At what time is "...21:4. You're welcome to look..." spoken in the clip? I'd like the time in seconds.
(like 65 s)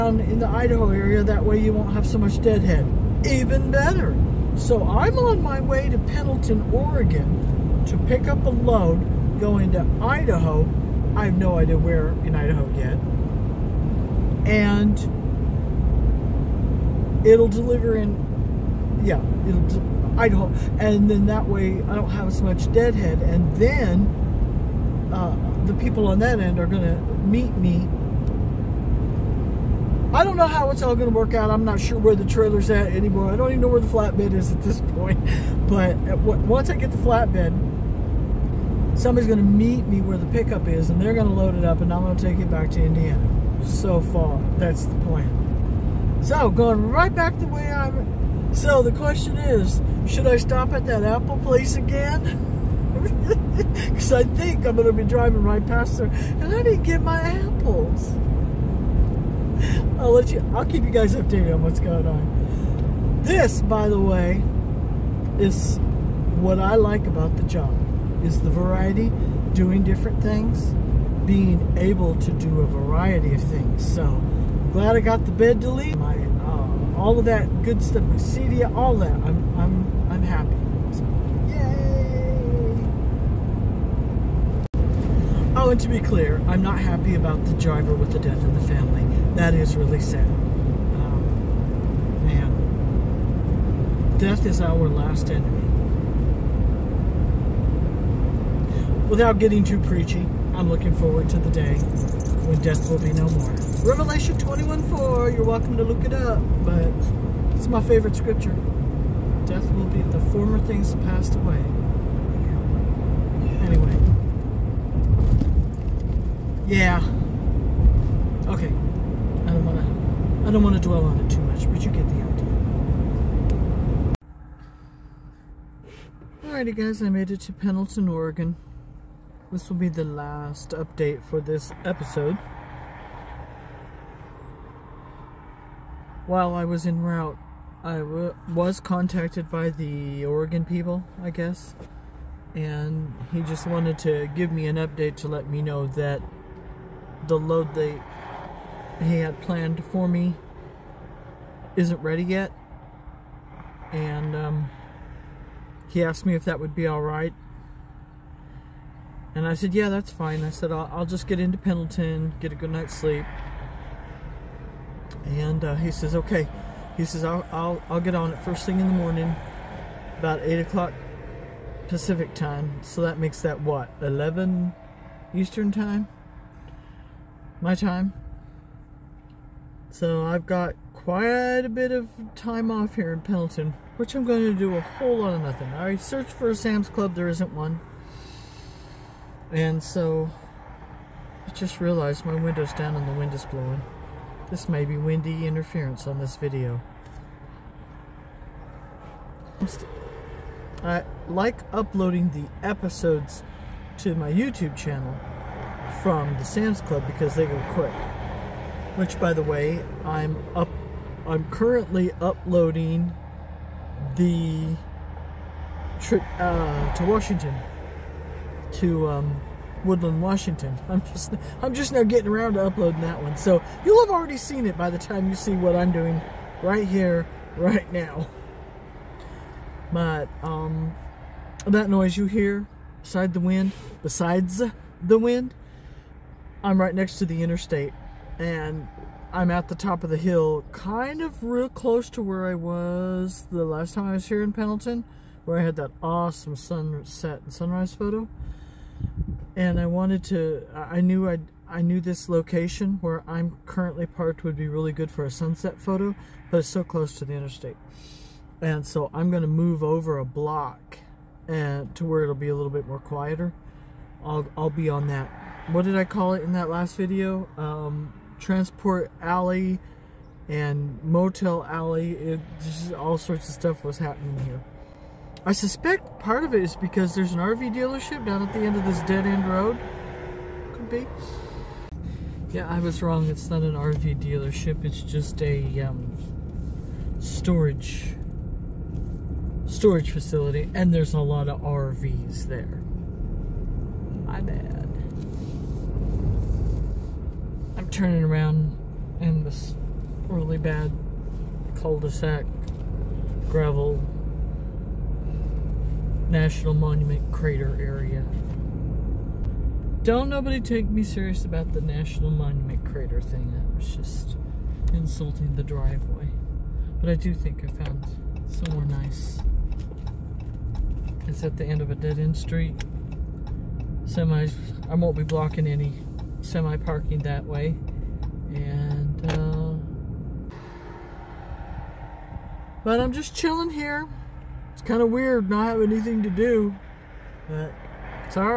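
104 s.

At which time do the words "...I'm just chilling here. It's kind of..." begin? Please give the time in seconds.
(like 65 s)
333 s.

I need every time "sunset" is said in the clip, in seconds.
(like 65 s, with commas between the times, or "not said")
246 s, 255 s.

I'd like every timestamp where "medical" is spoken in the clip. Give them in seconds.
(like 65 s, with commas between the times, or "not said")
not said.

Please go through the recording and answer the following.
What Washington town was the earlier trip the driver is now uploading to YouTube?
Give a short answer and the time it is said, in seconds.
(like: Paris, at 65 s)
Woodland, at 219 s.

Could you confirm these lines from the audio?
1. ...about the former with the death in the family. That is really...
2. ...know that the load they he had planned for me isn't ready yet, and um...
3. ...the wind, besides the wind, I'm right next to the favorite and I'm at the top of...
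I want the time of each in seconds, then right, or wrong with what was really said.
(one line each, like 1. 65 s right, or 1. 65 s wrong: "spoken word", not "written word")
1. 87 s wrong: "driver", not "former"
2. 145 s right
3. 233 s wrong: "interstate", not "favorite".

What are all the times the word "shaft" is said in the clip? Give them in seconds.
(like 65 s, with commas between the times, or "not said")
not said.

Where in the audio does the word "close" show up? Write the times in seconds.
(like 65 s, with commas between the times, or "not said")
241 s, 256 s.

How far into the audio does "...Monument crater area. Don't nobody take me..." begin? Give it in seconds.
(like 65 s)
306 s.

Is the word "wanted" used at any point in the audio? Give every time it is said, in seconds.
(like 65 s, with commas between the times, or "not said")
143 s, 249 s.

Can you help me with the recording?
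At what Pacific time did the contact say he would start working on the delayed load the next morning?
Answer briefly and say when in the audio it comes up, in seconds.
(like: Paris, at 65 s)
8 o'clock, at 170 s.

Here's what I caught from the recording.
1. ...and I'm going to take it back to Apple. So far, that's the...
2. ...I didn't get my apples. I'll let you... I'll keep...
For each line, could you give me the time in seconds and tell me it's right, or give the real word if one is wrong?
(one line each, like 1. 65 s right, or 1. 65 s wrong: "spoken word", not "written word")
1. 41 s wrong: "Indiana", not "Apple"
2. 56 s right.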